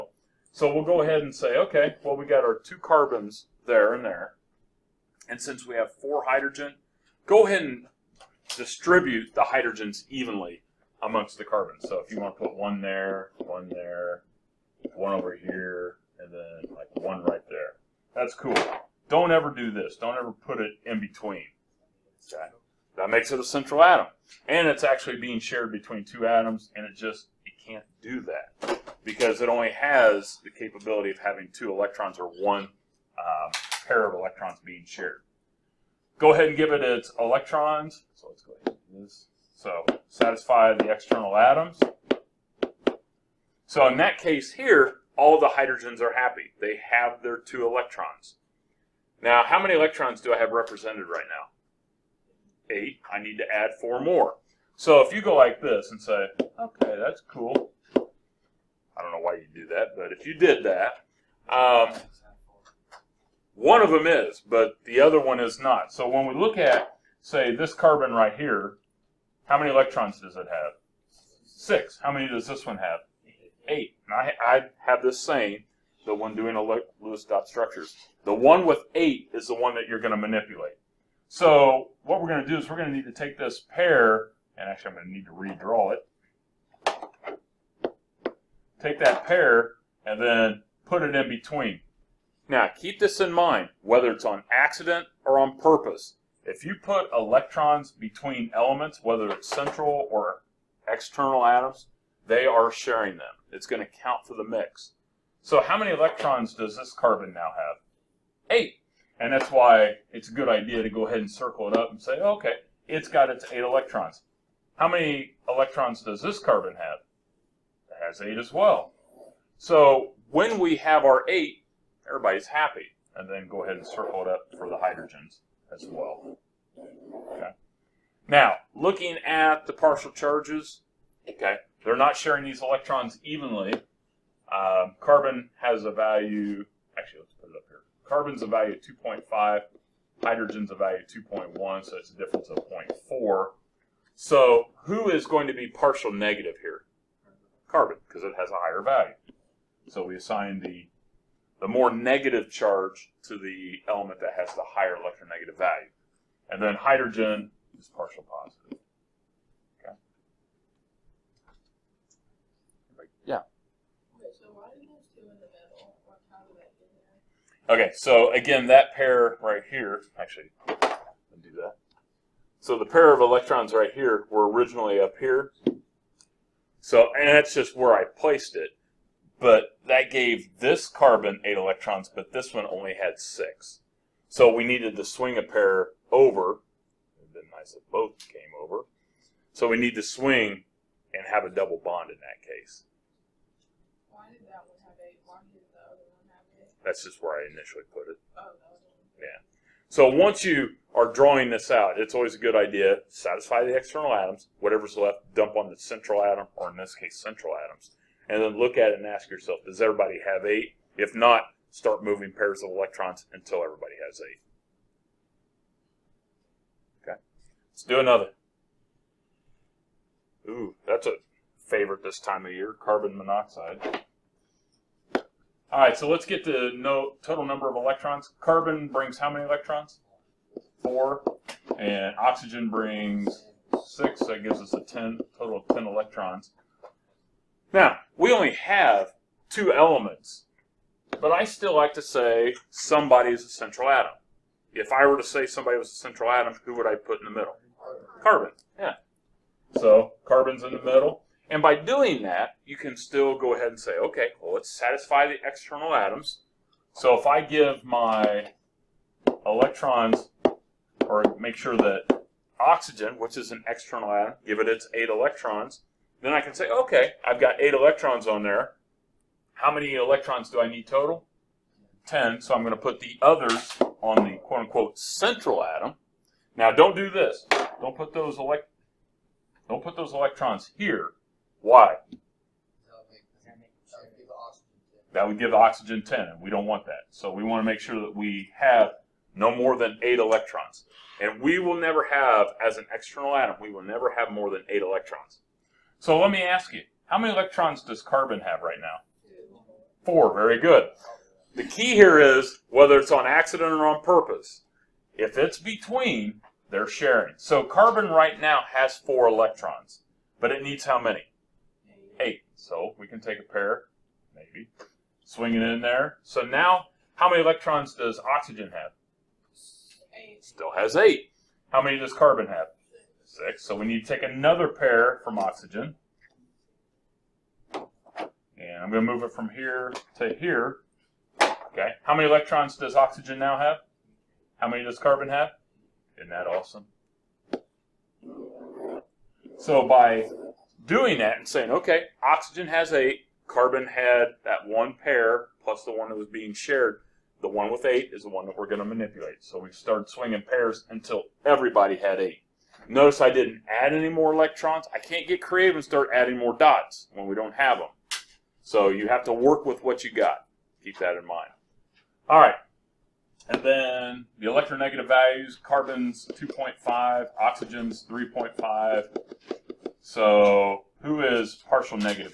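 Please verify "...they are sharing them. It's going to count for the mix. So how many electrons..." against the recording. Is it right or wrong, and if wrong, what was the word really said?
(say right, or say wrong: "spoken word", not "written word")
right.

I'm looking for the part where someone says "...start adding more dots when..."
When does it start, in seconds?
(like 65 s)
355 s.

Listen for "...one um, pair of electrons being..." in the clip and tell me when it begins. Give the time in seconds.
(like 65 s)
32 s.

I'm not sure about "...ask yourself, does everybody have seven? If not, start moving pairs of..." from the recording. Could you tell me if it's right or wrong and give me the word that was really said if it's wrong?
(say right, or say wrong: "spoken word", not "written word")
wrong: "eight", not "seven".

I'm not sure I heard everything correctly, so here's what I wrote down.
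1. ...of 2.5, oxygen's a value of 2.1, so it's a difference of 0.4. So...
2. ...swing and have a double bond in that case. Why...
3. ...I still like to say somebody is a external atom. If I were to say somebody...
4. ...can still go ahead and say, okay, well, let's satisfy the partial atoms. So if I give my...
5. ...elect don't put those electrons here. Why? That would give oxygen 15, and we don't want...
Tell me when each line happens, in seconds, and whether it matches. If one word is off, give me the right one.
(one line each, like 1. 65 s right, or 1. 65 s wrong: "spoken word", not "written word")
1. 138 s wrong: "hydrogen", not "oxygen"
2. 190 s right
3. 241 s wrong: "central", not "external"
4. 252 s wrong: "external", not "partial"
5. 278 s wrong: "10", not "15".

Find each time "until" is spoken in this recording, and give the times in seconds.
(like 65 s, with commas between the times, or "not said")
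213 s, 350 s.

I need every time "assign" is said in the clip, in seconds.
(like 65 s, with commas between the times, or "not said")
150 s.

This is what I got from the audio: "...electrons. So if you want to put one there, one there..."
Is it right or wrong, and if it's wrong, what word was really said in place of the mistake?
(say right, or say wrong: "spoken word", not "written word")
wrong: "carbons", not "electrons".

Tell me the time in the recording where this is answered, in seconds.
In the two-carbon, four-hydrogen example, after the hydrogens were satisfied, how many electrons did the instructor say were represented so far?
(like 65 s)
52 s.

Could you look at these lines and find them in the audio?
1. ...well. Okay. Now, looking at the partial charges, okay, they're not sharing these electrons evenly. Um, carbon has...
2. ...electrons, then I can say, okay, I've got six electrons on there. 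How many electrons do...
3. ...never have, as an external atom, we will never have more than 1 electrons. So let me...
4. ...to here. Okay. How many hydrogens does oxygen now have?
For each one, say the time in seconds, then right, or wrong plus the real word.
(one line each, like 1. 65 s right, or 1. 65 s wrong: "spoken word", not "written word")
1. 125 s right
2. 265 s wrong: "eight", not "six"
3. 291 s wrong: "8", not "1"
4. 330 s wrong: "electrons", not "hydrogens".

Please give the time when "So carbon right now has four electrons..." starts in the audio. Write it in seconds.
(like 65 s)
307 s.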